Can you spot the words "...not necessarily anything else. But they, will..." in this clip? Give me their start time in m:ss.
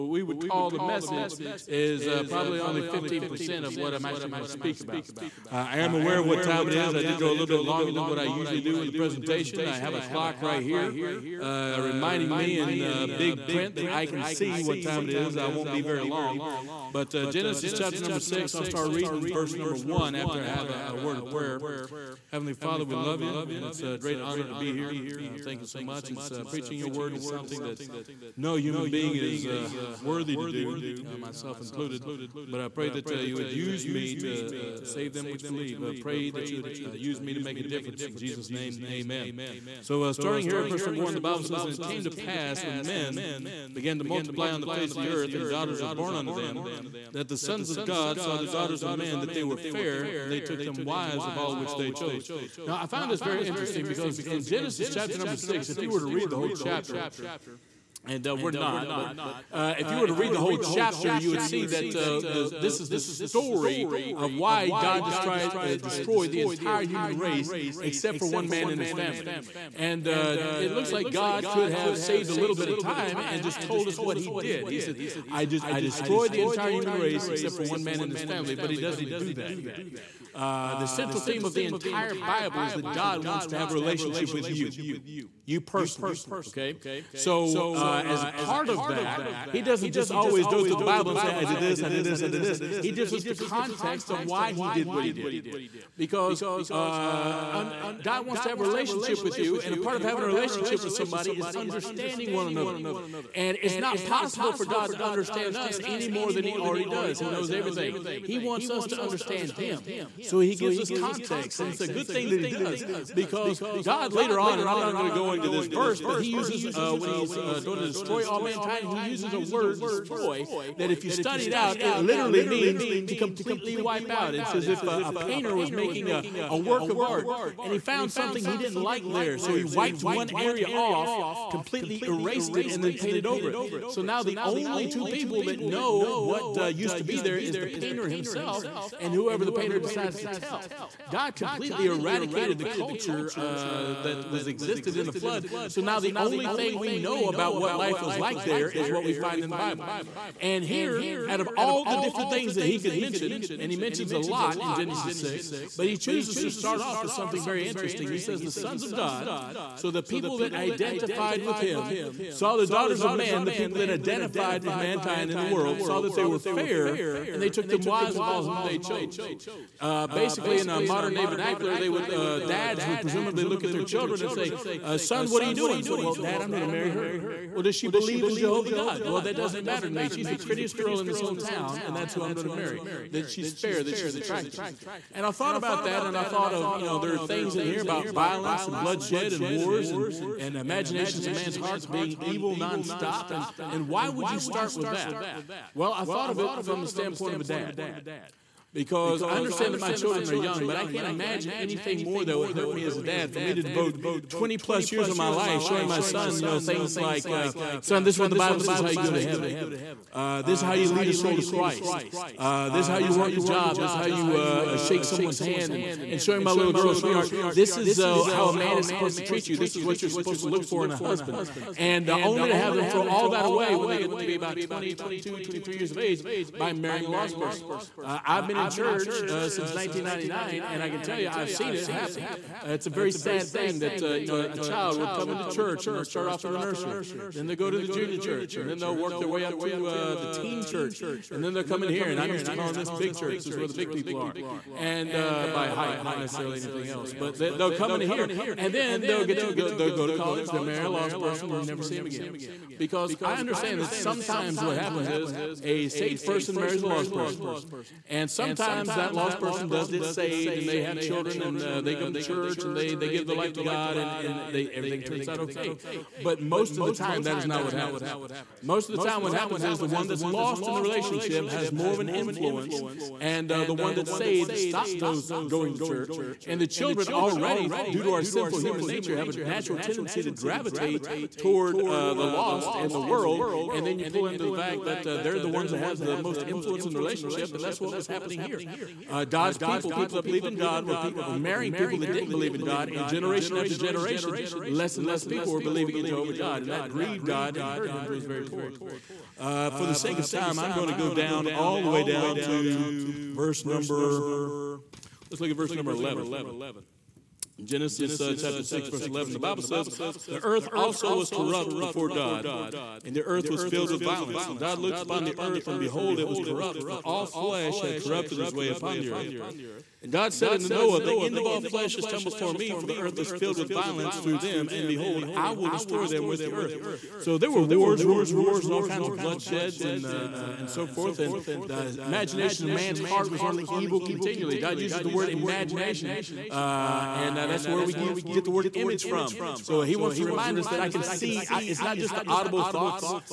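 4:06.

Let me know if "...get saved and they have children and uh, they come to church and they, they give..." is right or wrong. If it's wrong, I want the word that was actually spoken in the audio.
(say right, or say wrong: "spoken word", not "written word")
right.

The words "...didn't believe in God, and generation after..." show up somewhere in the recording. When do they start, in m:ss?
4:52.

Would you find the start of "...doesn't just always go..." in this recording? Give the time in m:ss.
1:29.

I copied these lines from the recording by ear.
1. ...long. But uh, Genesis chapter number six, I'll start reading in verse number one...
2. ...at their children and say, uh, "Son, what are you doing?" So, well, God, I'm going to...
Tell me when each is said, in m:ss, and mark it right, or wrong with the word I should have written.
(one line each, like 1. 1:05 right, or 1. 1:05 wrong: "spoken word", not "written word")
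1. 0:16 right
2. 2:53 wrong: "Dad", not "God".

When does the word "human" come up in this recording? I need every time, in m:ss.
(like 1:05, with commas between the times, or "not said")
0:28, 1:06, 1:16, 4:38.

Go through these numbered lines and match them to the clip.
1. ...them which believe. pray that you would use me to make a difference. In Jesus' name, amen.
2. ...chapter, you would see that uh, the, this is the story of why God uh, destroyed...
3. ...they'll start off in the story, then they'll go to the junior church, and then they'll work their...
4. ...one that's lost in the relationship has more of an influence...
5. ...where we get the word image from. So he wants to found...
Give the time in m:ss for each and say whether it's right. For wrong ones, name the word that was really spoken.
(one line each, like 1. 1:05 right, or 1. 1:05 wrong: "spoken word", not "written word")
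1. 0:35 right
2. 1:00 right
3. 3:55 wrong: "nursery", not "story"
4. 4:29 right
5. 5:37 wrong: "remind", not "found".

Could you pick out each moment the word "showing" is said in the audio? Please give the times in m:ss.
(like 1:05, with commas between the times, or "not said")
3:25, 3:36.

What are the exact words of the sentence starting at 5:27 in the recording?
So there were wars, rumors of wars, and all kinds of bloodsheds and, uh, uh, and so forth.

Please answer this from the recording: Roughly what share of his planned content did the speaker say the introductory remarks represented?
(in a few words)
15%.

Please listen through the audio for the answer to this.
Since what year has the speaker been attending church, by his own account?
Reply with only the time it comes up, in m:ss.
3:49.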